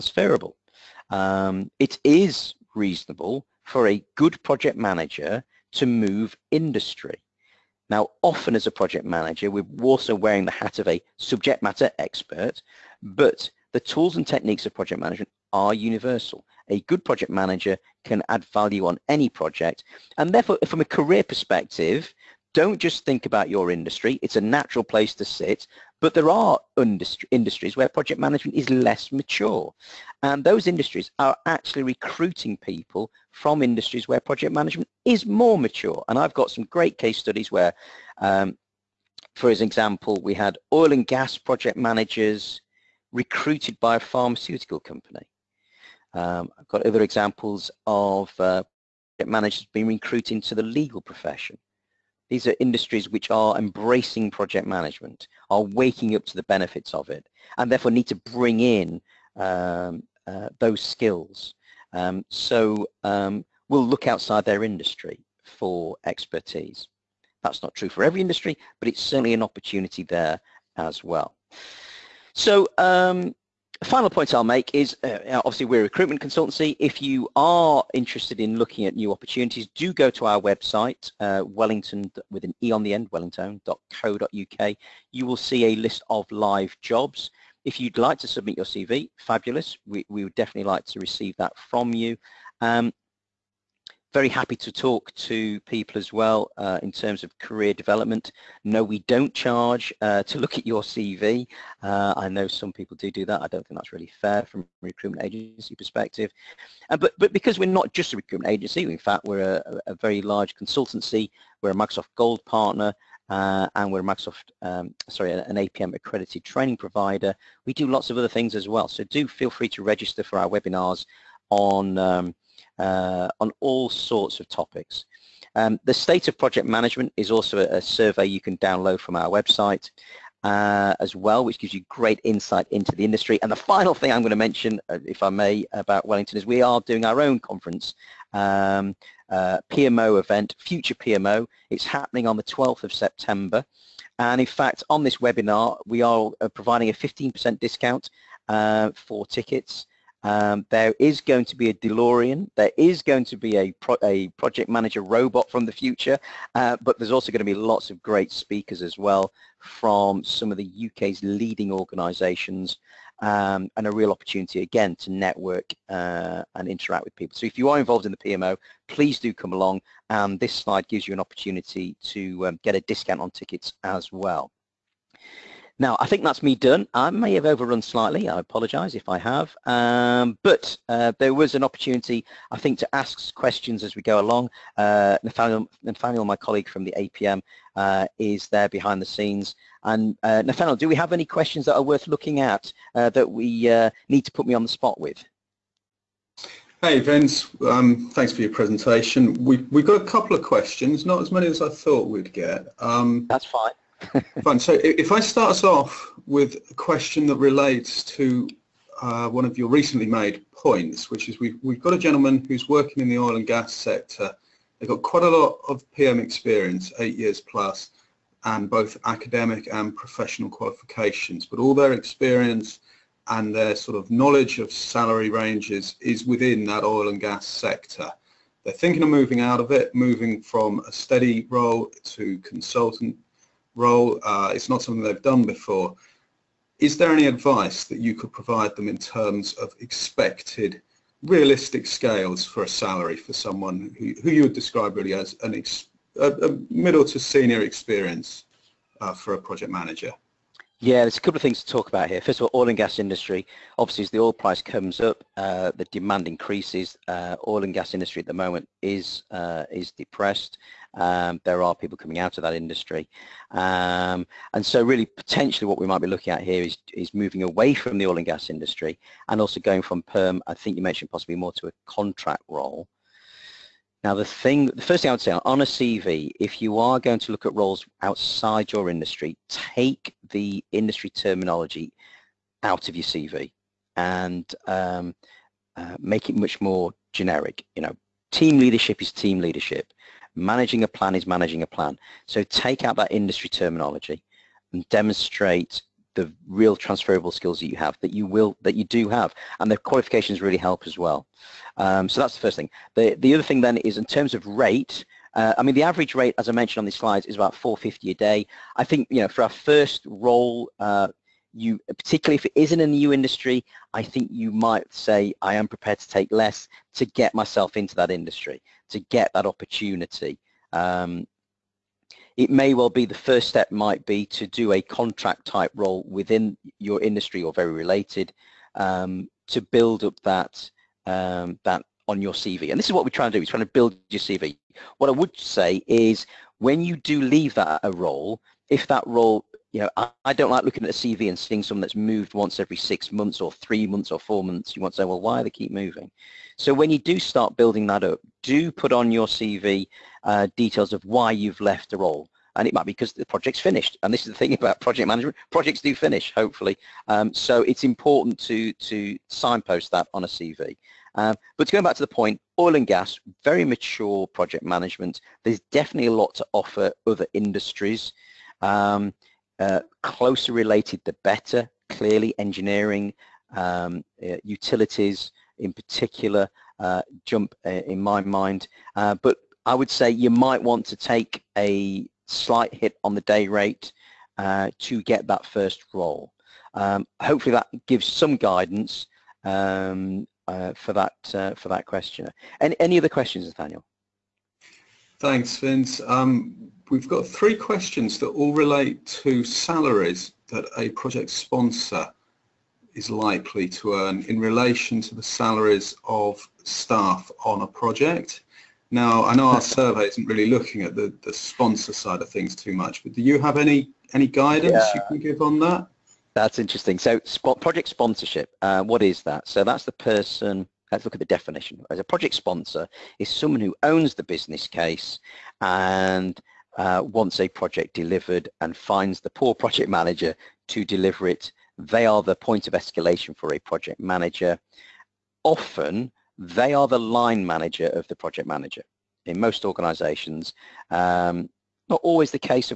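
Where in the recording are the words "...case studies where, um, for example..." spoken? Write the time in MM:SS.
00:36.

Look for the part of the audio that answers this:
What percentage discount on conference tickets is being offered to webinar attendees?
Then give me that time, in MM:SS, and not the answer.
02:26.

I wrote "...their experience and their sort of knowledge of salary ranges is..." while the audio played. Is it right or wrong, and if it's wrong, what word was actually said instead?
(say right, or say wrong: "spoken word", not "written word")
right.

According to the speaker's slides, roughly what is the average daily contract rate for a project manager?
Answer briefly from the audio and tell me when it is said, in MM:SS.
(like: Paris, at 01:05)
450 a day, at 05:07.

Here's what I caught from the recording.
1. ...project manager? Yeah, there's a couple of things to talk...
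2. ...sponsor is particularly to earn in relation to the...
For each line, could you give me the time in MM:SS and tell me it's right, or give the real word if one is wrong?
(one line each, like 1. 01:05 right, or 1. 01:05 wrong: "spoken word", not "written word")
1. 04:09 right
2. 06:41 wrong: "likely", not "particularly".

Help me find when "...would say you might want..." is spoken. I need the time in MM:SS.
06:19.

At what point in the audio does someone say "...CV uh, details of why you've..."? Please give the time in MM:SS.
05:49.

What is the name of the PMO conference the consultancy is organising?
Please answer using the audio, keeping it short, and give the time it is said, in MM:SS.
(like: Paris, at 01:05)
Future PMO, at 02:20.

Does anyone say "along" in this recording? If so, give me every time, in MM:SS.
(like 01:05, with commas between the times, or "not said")
02:49, 03:04.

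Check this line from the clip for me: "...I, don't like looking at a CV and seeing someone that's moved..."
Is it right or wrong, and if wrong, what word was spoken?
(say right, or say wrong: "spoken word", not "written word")
right.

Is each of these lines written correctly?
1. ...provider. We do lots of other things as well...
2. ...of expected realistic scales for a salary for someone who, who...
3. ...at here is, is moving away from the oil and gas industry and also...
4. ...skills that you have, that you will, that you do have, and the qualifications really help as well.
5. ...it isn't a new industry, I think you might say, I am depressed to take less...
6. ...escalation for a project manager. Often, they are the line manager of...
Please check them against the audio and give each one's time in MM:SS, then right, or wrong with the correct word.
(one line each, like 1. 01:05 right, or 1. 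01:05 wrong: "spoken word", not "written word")
1. 01:56 right
2. 03:59 right
3. 04:26 right
4. 04:57 right
5. 05:12 wrong: "prepared", not "depressed"
6. 07:12 right.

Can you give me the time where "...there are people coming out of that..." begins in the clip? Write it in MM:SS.
04:21.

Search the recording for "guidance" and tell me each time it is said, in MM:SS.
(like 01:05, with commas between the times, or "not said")
06:28, 06:54.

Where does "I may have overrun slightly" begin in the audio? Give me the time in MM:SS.
02:56.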